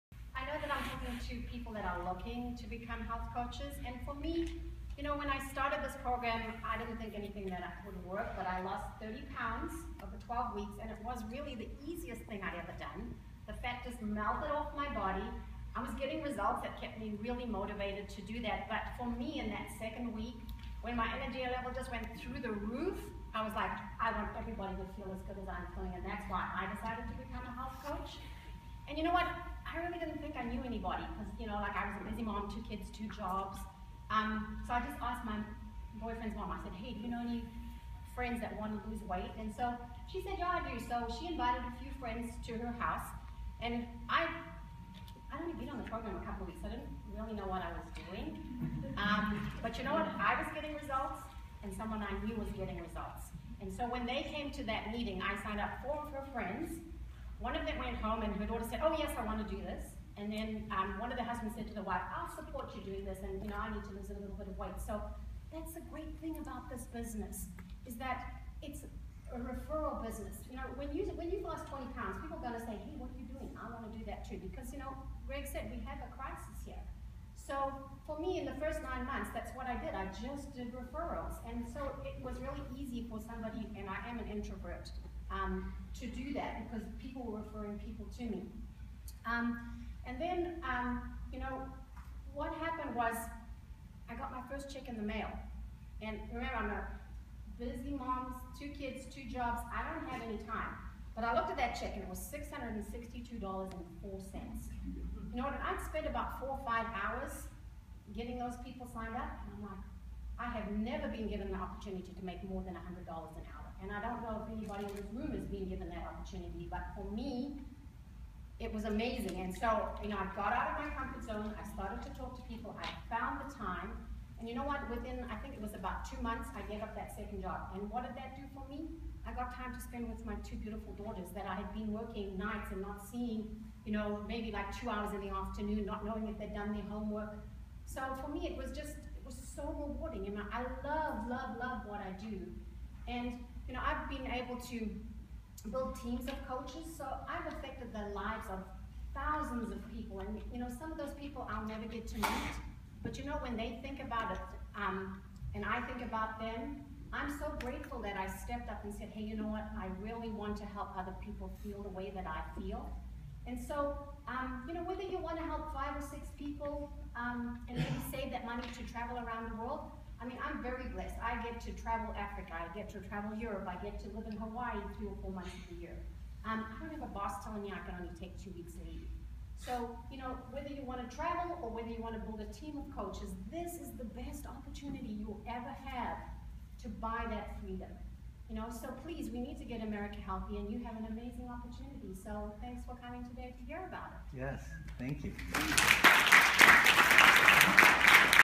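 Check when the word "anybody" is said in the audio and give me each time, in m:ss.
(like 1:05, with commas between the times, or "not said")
0:30, 1:54.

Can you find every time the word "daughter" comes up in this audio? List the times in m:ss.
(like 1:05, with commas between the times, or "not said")
0:58, 2:10.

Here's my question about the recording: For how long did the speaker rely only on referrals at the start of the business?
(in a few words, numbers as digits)
9 months.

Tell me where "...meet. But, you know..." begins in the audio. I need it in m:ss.
2:32.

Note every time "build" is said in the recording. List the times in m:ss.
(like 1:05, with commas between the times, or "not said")
2:25, 3:02.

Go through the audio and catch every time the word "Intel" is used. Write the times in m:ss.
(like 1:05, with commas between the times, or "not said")
not said.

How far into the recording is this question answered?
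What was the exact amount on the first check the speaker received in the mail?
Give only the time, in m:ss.
1:42.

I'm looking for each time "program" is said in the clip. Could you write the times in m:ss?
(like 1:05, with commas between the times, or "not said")
0:06, 0:45.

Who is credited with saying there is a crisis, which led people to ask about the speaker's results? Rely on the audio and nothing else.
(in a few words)
Greg.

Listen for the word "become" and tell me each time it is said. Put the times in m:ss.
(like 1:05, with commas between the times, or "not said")
0:02, 0:27.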